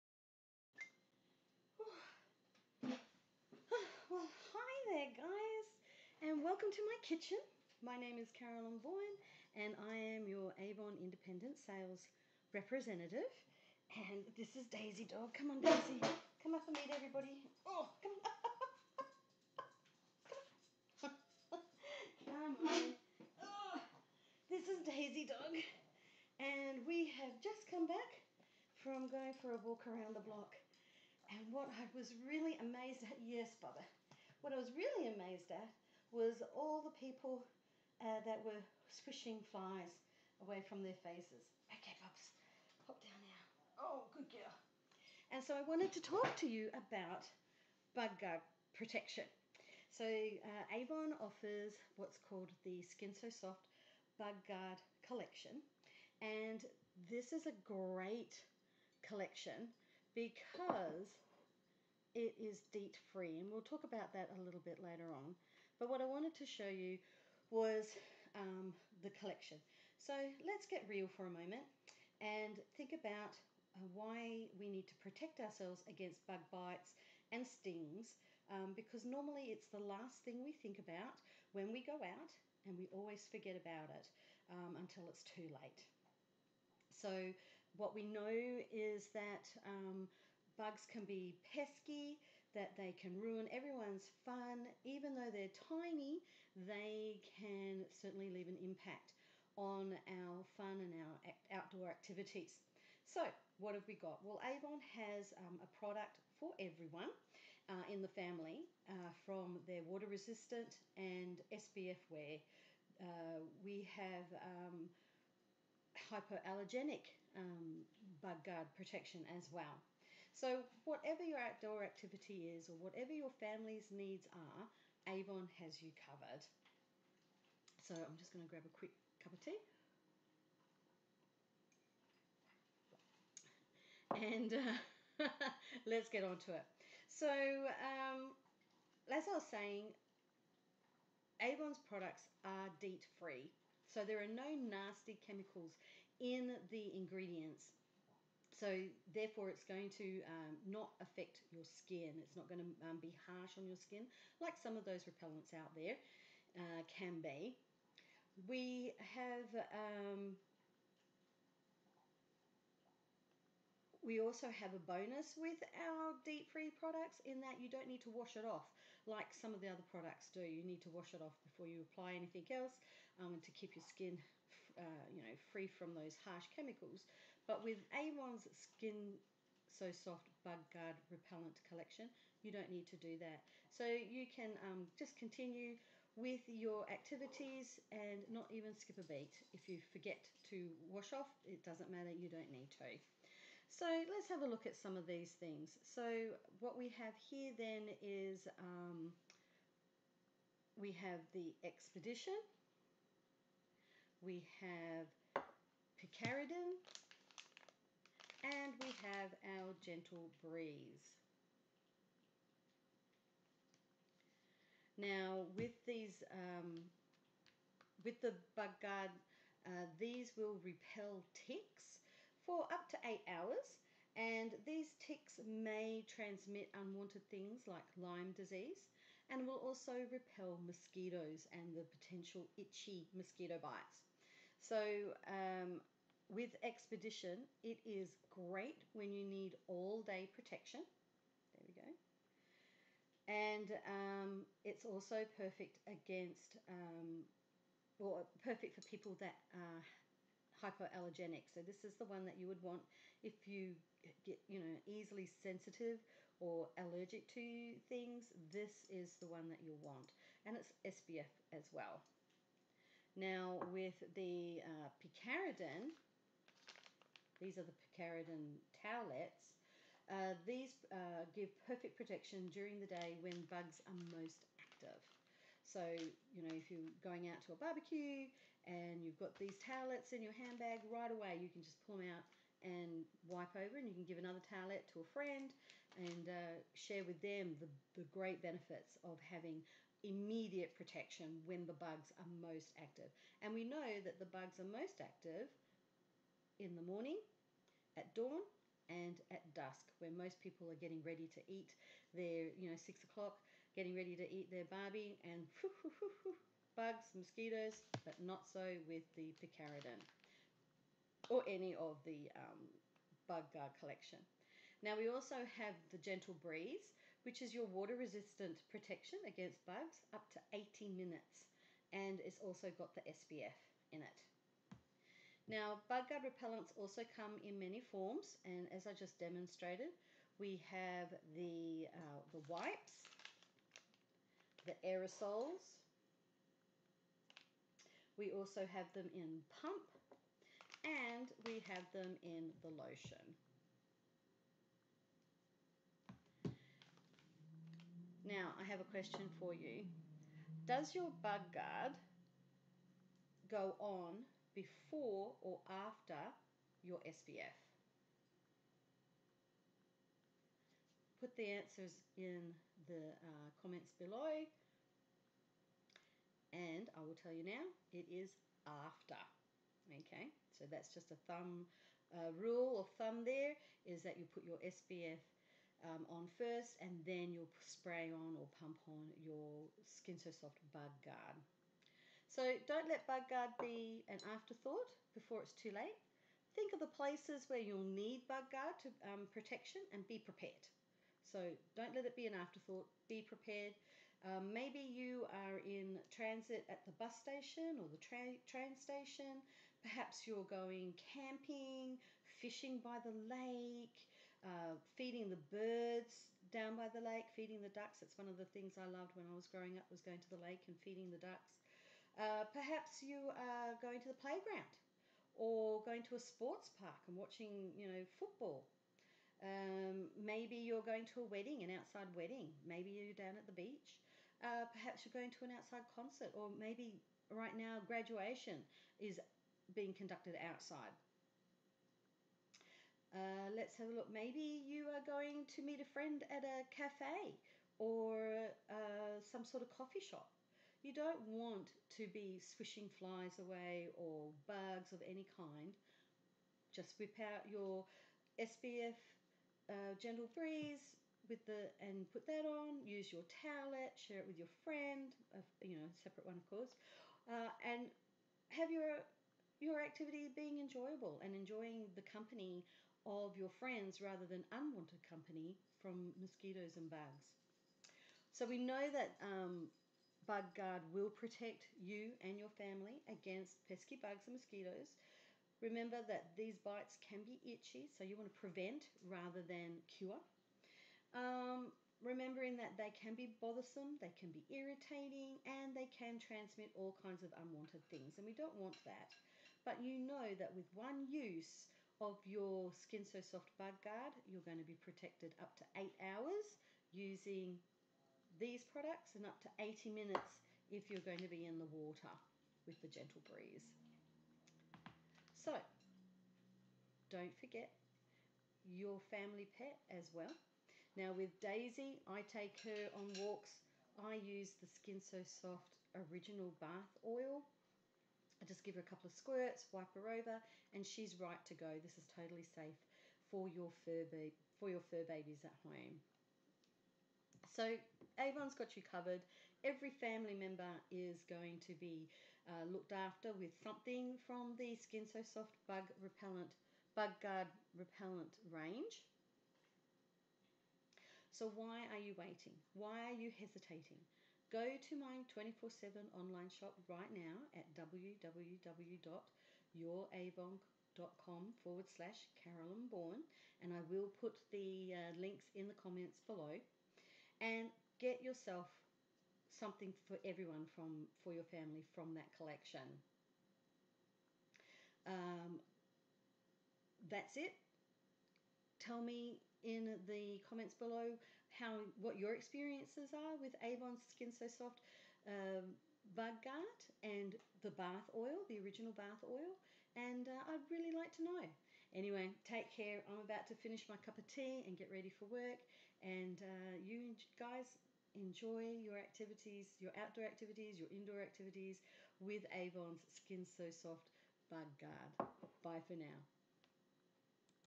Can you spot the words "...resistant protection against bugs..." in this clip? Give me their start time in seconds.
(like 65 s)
317 s.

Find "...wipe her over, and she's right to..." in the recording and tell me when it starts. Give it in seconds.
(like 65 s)
519 s.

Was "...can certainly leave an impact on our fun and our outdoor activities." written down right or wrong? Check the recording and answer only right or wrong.
right.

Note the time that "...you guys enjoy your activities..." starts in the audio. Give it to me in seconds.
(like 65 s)
586 s.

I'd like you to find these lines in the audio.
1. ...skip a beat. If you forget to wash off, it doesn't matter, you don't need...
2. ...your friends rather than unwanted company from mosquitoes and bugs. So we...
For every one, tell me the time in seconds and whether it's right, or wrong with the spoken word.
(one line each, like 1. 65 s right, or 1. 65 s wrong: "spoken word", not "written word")
1. 188 s right
2. 463 s right.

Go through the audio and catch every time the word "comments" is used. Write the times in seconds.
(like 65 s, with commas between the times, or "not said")
363 s, 555 s, 570 s.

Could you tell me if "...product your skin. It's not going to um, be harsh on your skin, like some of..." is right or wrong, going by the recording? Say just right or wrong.
wrong.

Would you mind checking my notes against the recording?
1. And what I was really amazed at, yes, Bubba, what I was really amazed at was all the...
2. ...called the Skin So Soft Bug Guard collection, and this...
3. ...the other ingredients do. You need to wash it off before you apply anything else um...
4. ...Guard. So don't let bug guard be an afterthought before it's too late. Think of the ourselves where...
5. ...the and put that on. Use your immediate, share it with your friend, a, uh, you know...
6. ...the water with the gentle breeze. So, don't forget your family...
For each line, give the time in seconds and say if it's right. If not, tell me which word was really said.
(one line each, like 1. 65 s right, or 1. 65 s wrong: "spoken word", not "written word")
1. 31 s right
2. 52 s right
3. 169 s wrong: "products", not "ingredients"
4. 381 s wrong: "places", not "ourselves"
5. 451 s wrong: "towelette", not "immediate"
6. 501 s right.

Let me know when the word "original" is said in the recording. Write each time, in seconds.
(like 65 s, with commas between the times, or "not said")
516 s, 578 s.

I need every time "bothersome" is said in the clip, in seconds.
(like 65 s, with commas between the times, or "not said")
483 s.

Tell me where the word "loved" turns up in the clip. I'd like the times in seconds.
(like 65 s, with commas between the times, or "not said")
408 s.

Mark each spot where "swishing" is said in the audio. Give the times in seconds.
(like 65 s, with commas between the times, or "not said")
38 s, 442 s.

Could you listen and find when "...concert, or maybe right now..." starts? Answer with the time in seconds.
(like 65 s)
425 s.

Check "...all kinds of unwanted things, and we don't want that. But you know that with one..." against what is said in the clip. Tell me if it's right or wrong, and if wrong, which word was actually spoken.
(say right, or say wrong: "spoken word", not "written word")
right.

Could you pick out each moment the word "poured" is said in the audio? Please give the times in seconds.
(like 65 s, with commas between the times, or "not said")
not said.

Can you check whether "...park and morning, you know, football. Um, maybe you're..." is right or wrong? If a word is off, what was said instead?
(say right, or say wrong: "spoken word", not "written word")
wrong: "watching", not "morning".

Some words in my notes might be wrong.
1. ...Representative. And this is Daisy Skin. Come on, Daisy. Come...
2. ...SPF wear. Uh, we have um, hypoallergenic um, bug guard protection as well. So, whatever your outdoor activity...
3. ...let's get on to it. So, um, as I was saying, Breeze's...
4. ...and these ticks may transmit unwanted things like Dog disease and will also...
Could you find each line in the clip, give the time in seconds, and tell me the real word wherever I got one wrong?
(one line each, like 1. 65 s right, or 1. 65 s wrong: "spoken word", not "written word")
1. 12 s wrong: "Dog", not "Skin"
2. 111 s right
3. 135 s wrong: "Avon", not "Breeze"
4. 224 s wrong: "Lyme", not "Dog".